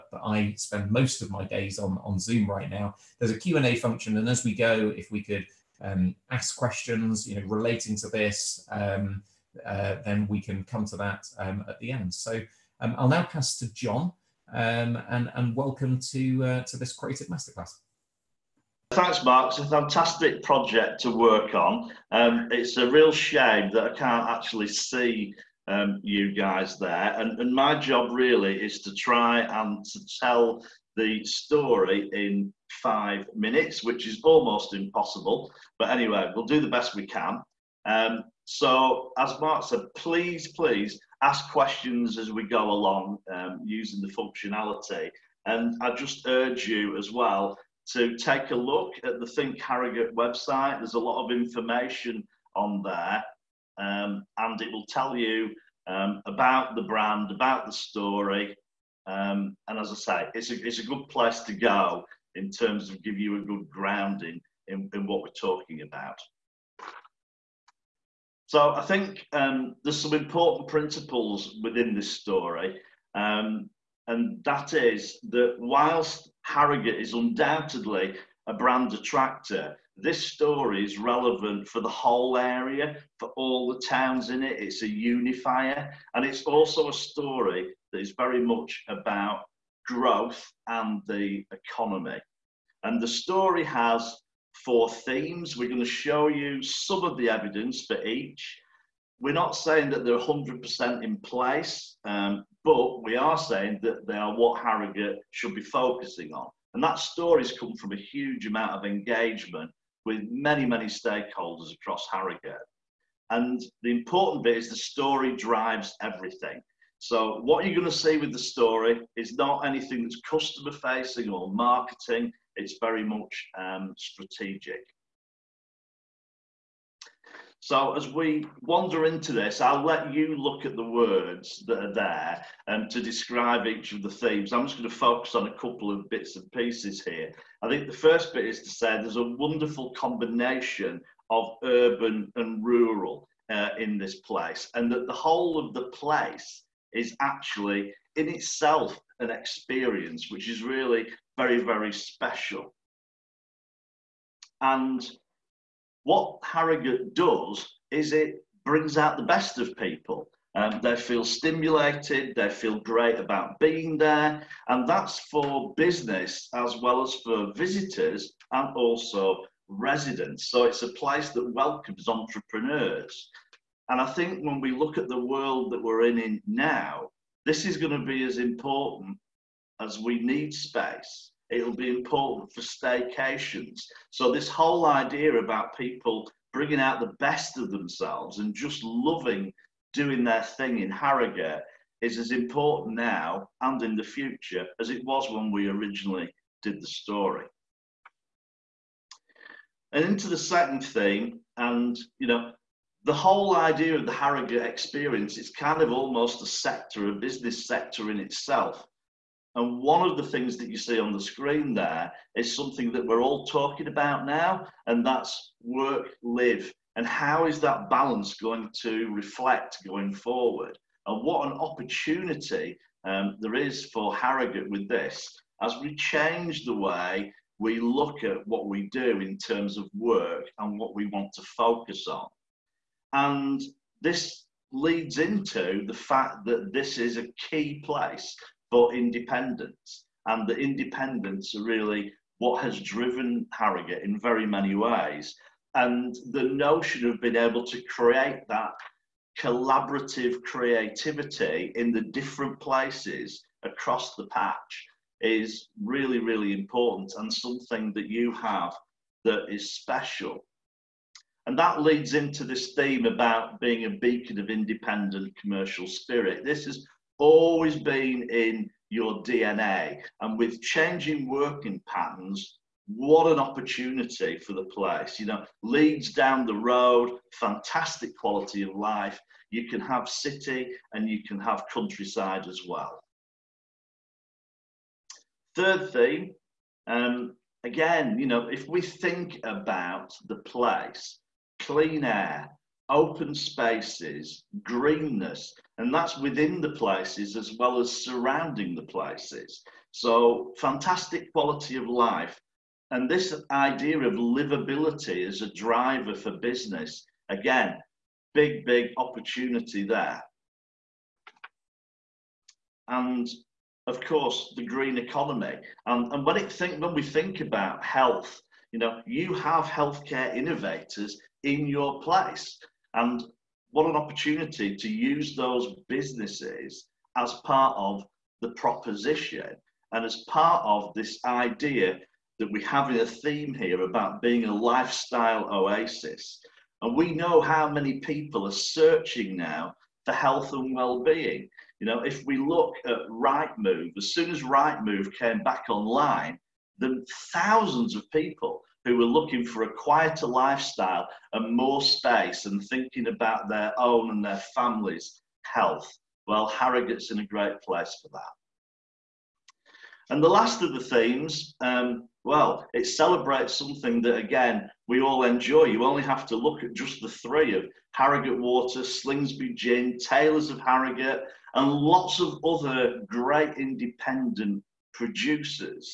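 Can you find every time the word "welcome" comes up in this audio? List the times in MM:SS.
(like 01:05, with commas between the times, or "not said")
00:15, 02:51.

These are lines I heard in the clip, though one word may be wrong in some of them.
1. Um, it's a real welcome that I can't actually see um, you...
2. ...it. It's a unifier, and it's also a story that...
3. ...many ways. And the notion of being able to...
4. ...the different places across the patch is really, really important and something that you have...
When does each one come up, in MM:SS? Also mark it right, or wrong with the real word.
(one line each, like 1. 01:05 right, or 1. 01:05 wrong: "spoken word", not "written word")
1. 00:22 wrong: "shame", not "welcome"
2. 01:24 right
3. 04:04 right
4. 04:11 right.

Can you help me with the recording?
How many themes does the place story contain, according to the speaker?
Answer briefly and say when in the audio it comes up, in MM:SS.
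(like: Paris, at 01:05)
4, at 01:34.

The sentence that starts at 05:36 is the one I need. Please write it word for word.
And we know how many people are searching now for health and well-being.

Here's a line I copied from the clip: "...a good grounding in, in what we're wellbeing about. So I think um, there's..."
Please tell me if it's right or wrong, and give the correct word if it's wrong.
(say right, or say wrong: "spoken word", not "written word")
wrong: "talking", not "wellbeing".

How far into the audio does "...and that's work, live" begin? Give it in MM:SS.
03:34.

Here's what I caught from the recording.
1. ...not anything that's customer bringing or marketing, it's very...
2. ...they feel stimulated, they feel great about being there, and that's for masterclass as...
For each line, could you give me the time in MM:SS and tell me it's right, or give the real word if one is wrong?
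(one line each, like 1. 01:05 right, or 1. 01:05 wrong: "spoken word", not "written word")
1. 01:59 wrong: "facing", not "bringing"
2. 02:40 wrong: "business", not "masterclass".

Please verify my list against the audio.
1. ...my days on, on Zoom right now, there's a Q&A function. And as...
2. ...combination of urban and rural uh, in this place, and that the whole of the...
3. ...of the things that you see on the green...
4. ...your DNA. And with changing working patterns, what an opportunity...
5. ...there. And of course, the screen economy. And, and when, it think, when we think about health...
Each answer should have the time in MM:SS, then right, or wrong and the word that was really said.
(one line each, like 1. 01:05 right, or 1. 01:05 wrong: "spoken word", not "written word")
1. 00:01 right
2. 02:19 right
3. 03:30 wrong: "screen", not "green"
4. 04:28 right
5. 05:09 wrong: "green", not "screen".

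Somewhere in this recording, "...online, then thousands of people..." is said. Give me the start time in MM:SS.
05:45.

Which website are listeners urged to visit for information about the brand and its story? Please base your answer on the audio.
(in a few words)
Think Harrogate.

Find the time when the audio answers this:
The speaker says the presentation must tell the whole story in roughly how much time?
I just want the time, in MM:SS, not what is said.
00:32.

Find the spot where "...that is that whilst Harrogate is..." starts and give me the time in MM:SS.
01:14.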